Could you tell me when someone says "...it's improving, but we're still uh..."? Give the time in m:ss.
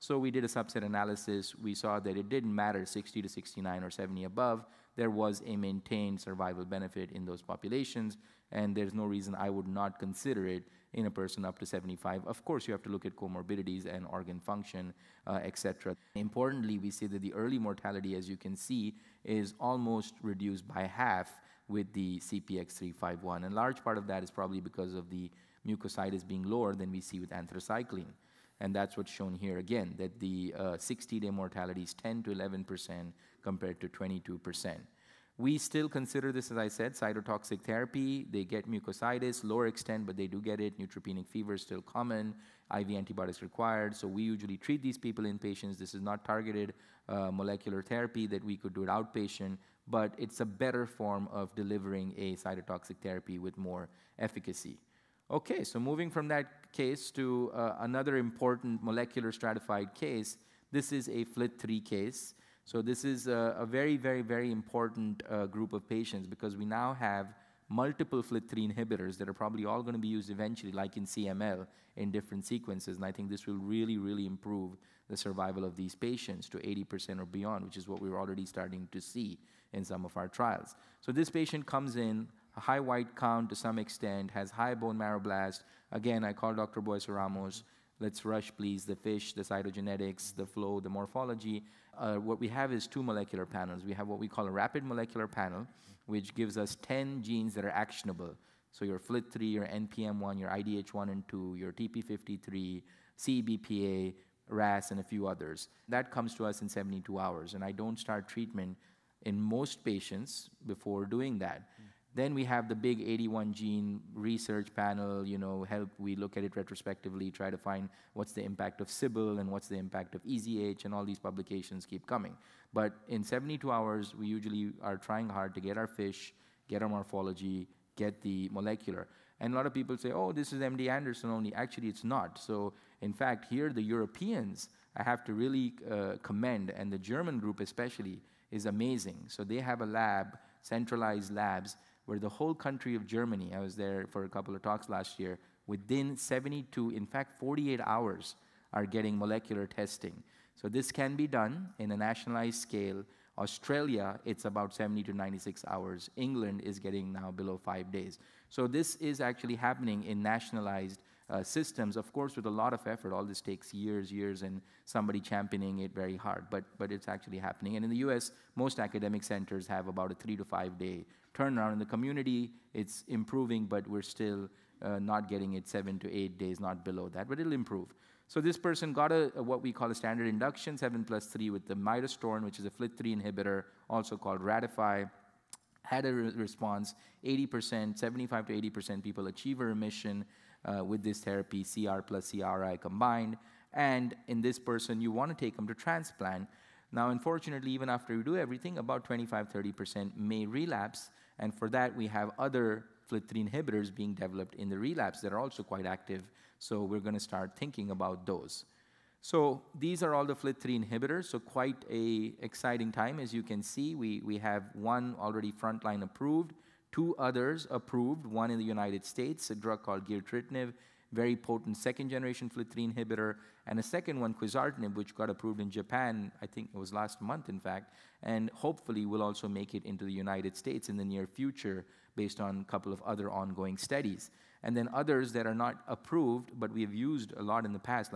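2:52.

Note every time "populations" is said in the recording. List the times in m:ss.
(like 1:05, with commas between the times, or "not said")
0:07.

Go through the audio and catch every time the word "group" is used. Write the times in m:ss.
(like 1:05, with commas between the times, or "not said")
1:05, 2:17.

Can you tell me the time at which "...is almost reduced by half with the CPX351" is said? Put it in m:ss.
0:19.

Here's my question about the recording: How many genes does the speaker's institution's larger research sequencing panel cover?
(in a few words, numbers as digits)
81.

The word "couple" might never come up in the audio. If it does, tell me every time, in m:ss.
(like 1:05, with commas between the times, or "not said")
2:24, 3:52.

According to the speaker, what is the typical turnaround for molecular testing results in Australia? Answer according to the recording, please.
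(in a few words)
70 to 96 hours.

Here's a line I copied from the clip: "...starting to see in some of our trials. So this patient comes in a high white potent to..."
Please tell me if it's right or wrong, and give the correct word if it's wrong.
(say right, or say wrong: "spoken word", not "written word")
wrong: "count", not "potent".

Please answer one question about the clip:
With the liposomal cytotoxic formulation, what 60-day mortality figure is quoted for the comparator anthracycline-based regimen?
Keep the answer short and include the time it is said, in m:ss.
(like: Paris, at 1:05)
22%, at 0:33.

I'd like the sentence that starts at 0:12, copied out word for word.
Of course, you have to look at comorbidities and organ function, uh, etc.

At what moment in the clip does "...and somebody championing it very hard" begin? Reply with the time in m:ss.
2:44.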